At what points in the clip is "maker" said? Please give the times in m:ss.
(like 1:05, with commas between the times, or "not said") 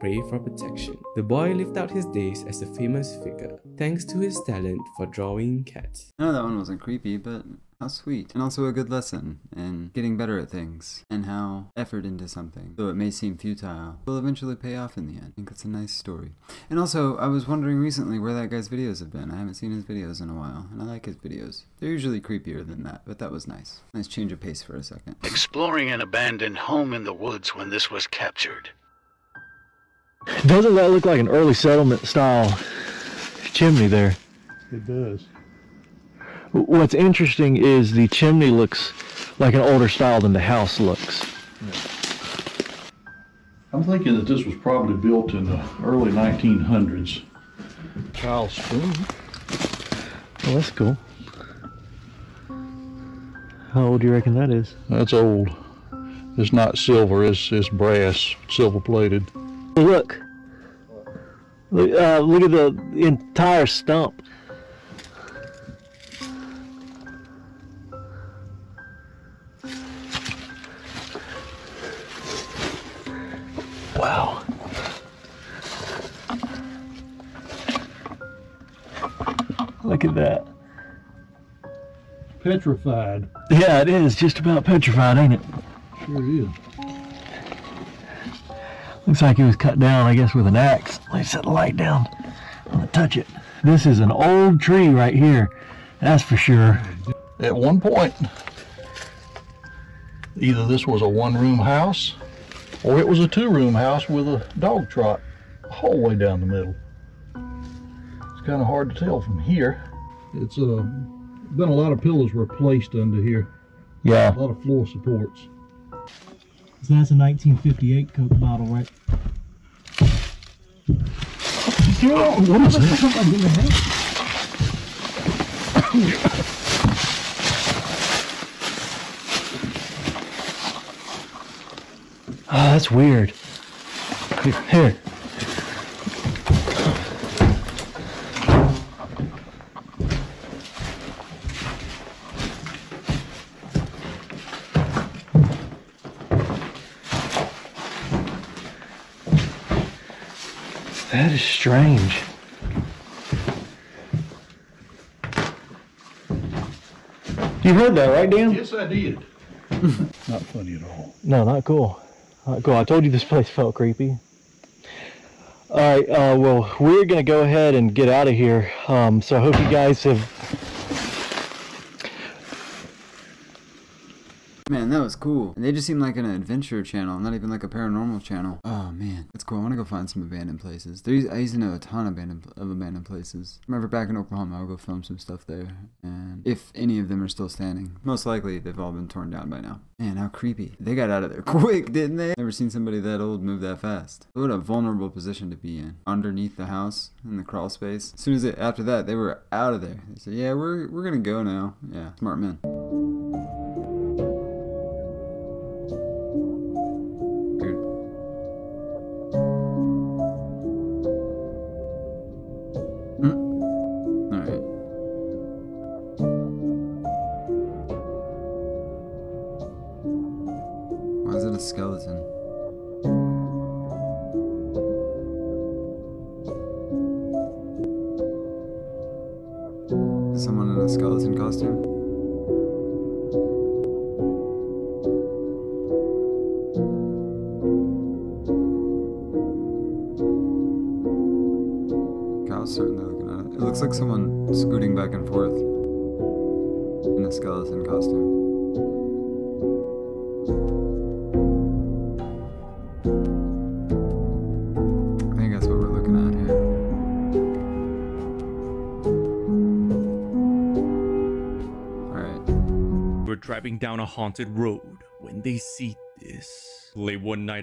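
not said.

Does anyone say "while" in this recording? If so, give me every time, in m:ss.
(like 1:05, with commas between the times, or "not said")
0:20.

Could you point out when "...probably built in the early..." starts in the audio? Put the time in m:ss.
0:44.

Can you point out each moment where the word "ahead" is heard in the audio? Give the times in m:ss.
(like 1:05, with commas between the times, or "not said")
2:47.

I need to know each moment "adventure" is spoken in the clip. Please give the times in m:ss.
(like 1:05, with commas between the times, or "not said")
2:56.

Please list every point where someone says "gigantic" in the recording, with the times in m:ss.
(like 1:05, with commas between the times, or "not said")
not said.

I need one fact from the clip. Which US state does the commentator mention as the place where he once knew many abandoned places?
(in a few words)
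Oklahoma.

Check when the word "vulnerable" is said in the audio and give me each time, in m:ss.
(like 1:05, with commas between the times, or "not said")
3:14.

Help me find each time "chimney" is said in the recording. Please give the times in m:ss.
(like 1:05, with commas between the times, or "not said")
0:33, 0:38.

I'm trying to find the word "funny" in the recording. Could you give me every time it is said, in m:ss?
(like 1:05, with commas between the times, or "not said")
2:40.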